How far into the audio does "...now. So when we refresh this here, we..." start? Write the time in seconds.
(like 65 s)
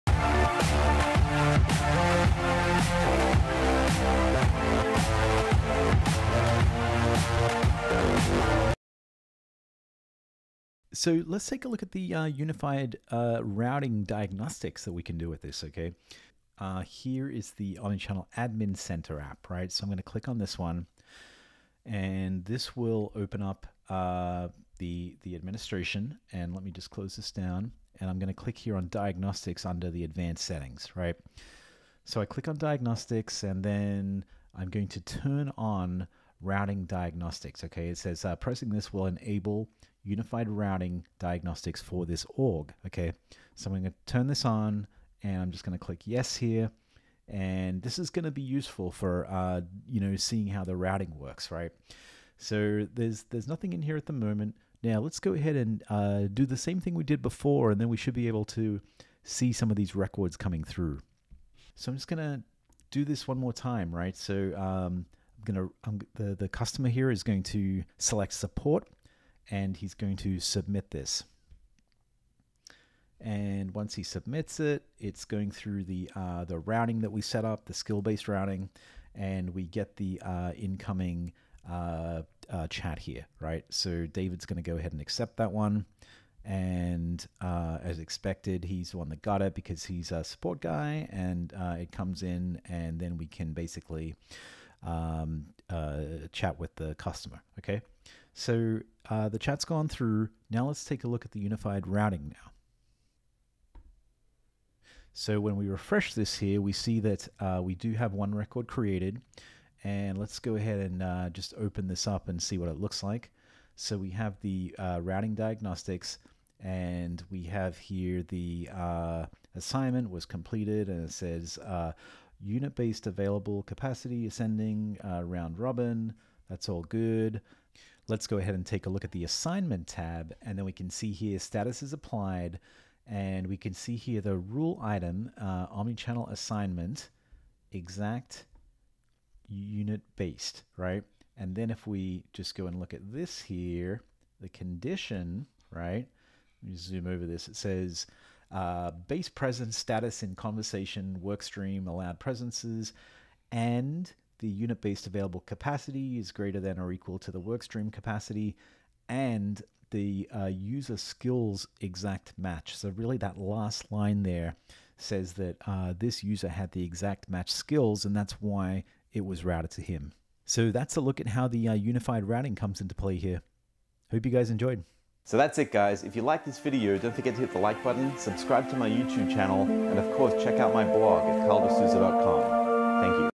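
102 s.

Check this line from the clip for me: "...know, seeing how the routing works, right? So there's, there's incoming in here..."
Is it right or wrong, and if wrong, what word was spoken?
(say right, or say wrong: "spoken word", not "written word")
wrong: "nothing", not "incoming".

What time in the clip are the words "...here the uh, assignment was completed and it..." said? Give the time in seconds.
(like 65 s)
117 s.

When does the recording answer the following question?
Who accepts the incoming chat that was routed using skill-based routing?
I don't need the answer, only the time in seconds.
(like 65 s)
84 s.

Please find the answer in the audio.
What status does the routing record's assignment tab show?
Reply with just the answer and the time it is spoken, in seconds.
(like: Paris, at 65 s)
applied, at 131 s.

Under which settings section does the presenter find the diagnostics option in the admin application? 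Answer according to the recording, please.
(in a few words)
advanced settings.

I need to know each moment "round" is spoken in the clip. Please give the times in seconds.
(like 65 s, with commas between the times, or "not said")
125 s.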